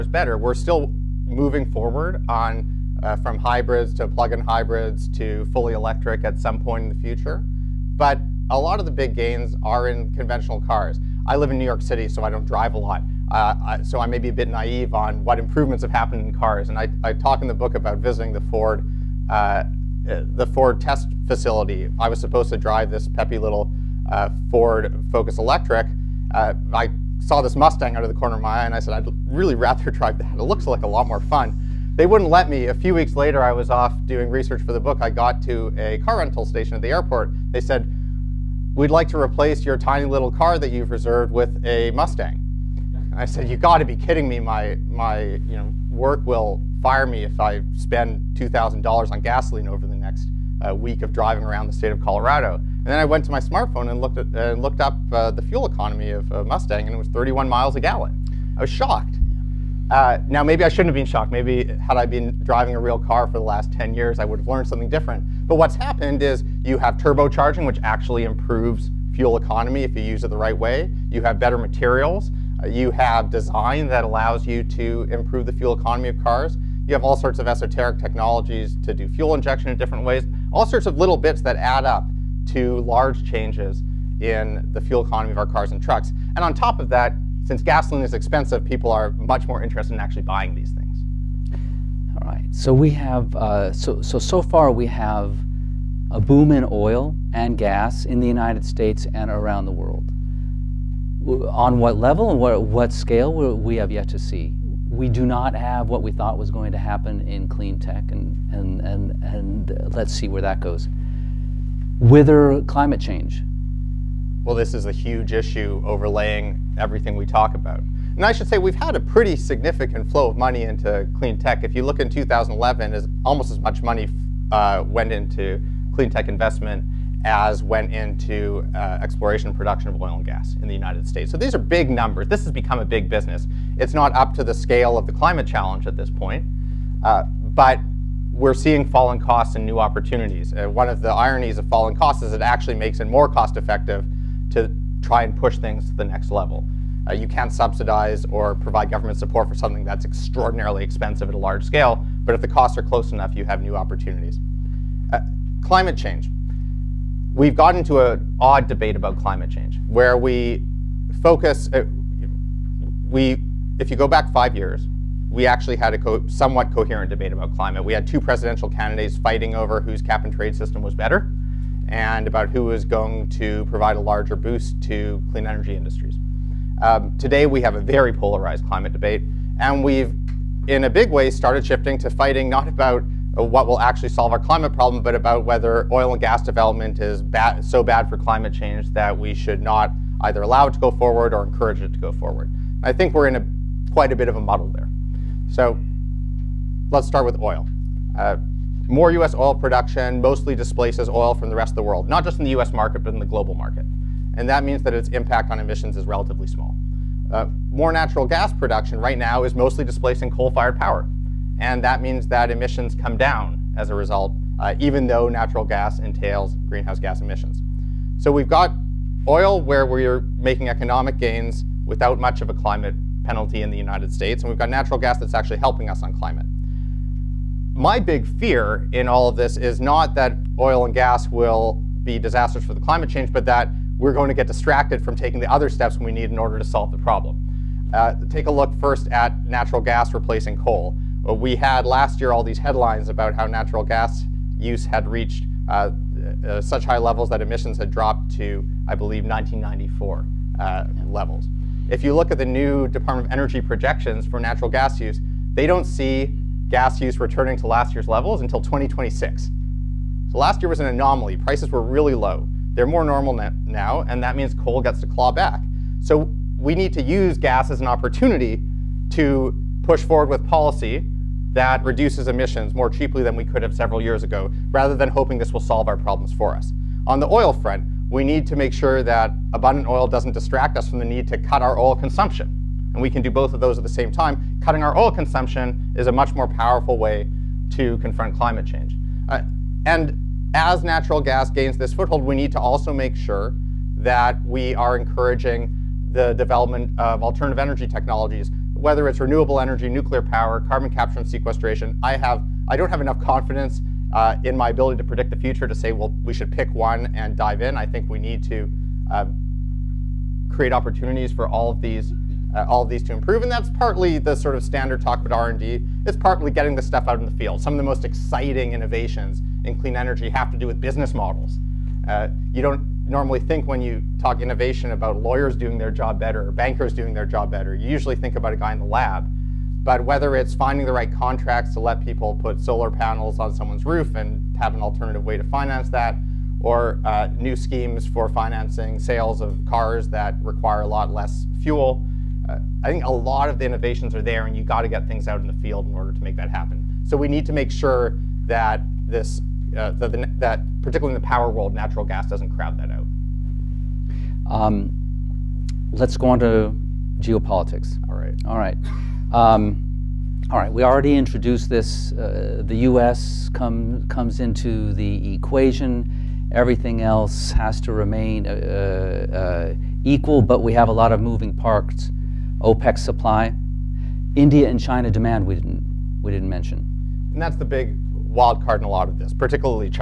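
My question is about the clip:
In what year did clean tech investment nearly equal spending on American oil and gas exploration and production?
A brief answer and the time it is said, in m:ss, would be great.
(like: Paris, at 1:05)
2011, at 2:02.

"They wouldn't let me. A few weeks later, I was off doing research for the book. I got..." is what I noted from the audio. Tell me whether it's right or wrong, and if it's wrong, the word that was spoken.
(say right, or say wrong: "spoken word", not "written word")
right.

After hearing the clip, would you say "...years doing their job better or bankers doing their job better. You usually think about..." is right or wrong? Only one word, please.
wrong.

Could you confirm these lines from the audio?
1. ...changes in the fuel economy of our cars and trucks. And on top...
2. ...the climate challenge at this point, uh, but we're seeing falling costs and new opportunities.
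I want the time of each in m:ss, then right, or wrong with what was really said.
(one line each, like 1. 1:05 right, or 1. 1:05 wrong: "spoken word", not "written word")
1. 1:23 right
2. 2:15 right.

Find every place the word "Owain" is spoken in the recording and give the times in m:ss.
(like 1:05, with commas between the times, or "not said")
not said.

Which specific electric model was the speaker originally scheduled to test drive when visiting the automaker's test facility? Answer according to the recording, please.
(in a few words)
Ford Focus Electric.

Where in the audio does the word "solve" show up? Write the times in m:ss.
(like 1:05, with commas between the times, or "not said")
3:04, 3:56, 4:35.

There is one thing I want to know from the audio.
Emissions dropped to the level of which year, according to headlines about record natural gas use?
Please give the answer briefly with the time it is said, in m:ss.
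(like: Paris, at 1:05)
1994, at 4:09.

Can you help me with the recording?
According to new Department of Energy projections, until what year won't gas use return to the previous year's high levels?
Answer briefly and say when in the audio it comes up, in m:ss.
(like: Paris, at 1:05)
2026, at 4:18.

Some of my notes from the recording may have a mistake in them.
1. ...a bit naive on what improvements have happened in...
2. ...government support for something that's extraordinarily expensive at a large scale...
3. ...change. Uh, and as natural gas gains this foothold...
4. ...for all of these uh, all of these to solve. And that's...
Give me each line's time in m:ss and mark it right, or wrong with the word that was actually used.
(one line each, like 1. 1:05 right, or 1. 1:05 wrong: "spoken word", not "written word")
1. 0:14 right
2. 2:28 right
3. 4:48 right
4. 5:11 wrong: "improve", not "solve".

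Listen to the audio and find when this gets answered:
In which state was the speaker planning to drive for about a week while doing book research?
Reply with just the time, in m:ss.
0:51.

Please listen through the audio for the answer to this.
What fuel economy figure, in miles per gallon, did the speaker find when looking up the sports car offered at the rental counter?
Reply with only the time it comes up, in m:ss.
0:57.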